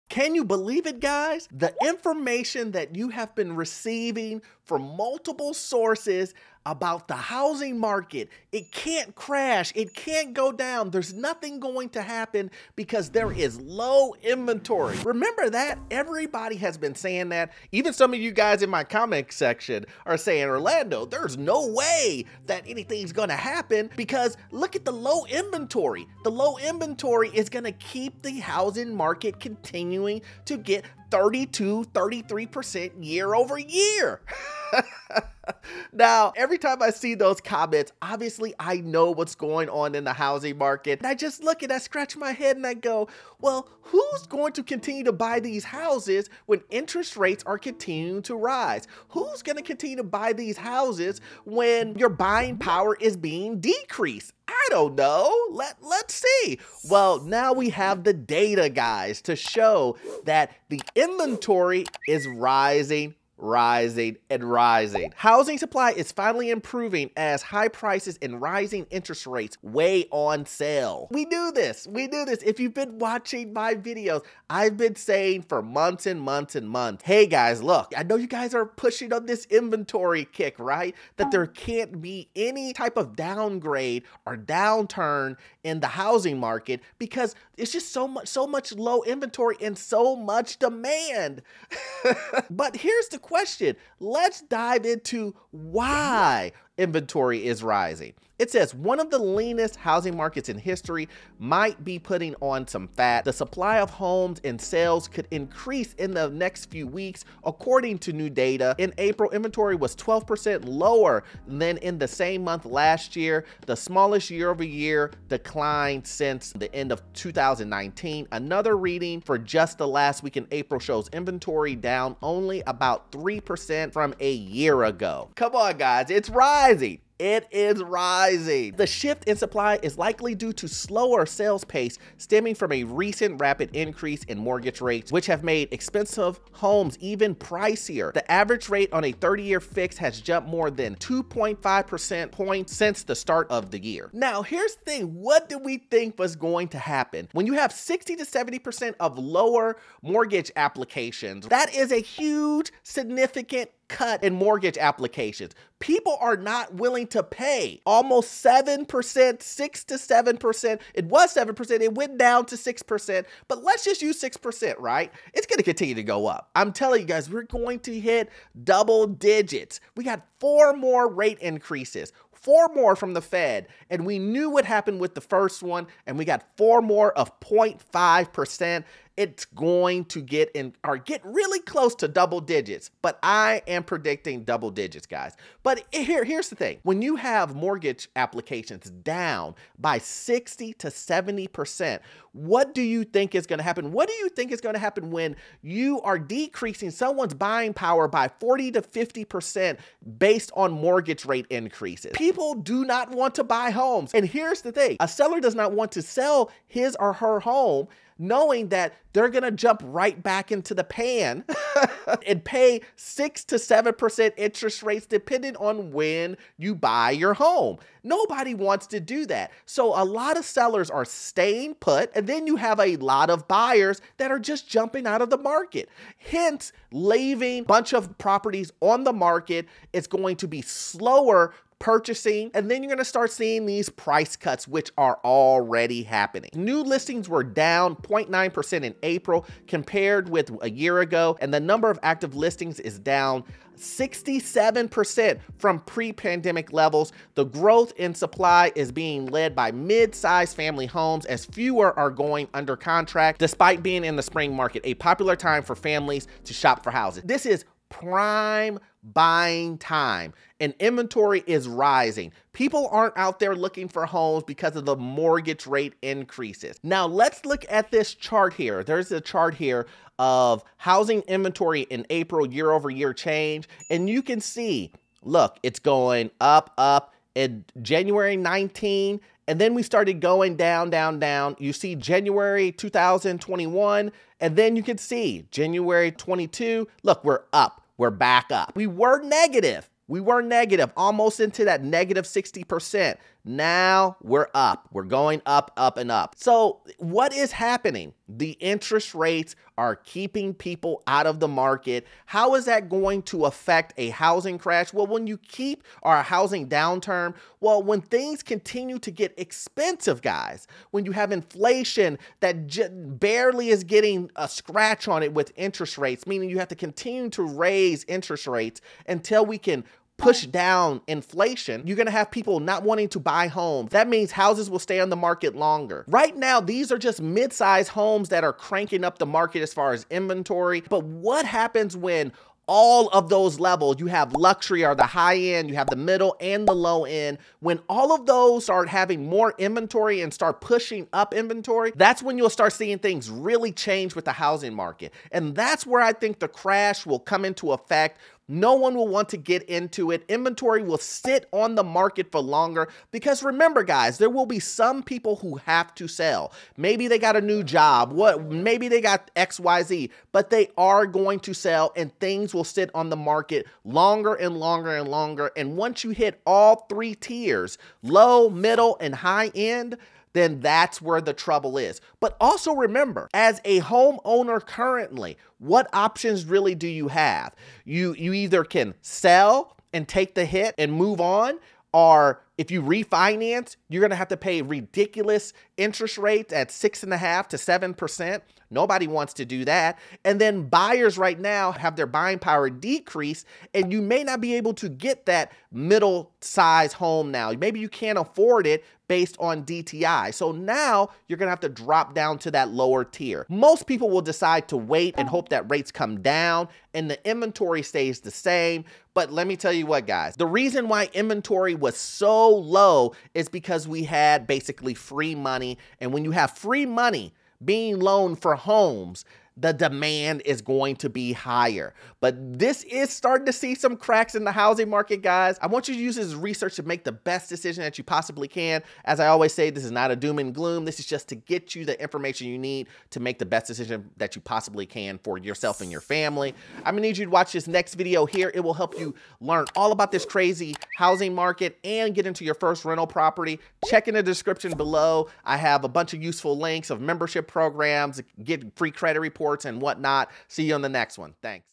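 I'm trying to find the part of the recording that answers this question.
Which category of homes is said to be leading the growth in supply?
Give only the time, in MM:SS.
04:09.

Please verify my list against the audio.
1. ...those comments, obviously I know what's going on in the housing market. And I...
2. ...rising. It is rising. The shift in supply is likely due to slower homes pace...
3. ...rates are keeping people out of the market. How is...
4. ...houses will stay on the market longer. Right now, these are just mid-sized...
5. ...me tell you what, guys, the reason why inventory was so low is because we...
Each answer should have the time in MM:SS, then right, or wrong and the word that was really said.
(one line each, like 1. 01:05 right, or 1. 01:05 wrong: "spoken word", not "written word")
1. 00:37 right
2. 02:06 wrong: "sales", not "homes"
3. 04:59 right
4. 05:24 right
5. 06:49 right.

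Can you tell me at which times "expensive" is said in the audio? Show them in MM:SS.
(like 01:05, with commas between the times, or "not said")
02:15, 05:09.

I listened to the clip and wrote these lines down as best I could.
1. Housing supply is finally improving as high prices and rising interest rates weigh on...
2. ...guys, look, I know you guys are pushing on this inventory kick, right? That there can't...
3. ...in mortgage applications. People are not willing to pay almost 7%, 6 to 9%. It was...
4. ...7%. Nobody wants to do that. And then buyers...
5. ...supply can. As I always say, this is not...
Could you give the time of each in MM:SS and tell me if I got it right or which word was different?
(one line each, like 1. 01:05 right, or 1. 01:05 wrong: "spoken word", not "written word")
1. 01:05 right
2. 01:17 right
3. 02:34 wrong: "7", not "9"
4. 06:27 right
5. 07:08 wrong: "possibly", not "supply".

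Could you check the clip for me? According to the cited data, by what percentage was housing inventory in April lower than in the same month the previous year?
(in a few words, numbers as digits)
12%.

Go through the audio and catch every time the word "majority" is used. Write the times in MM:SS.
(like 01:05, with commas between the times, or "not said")
not said.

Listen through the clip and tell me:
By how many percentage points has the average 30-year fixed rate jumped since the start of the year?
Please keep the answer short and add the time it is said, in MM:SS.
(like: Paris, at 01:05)
2.5, at 02:20.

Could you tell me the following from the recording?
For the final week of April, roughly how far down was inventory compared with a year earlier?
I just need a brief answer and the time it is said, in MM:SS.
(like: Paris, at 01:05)
3%, at 02:02.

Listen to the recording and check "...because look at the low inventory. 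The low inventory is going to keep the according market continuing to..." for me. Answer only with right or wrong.
wrong.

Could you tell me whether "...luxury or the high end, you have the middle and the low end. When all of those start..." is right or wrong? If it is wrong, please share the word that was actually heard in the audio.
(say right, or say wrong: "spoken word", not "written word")
right.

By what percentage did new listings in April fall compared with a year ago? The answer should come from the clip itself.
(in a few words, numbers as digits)
0.9%.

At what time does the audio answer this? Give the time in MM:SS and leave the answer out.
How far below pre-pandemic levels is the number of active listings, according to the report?
04:03.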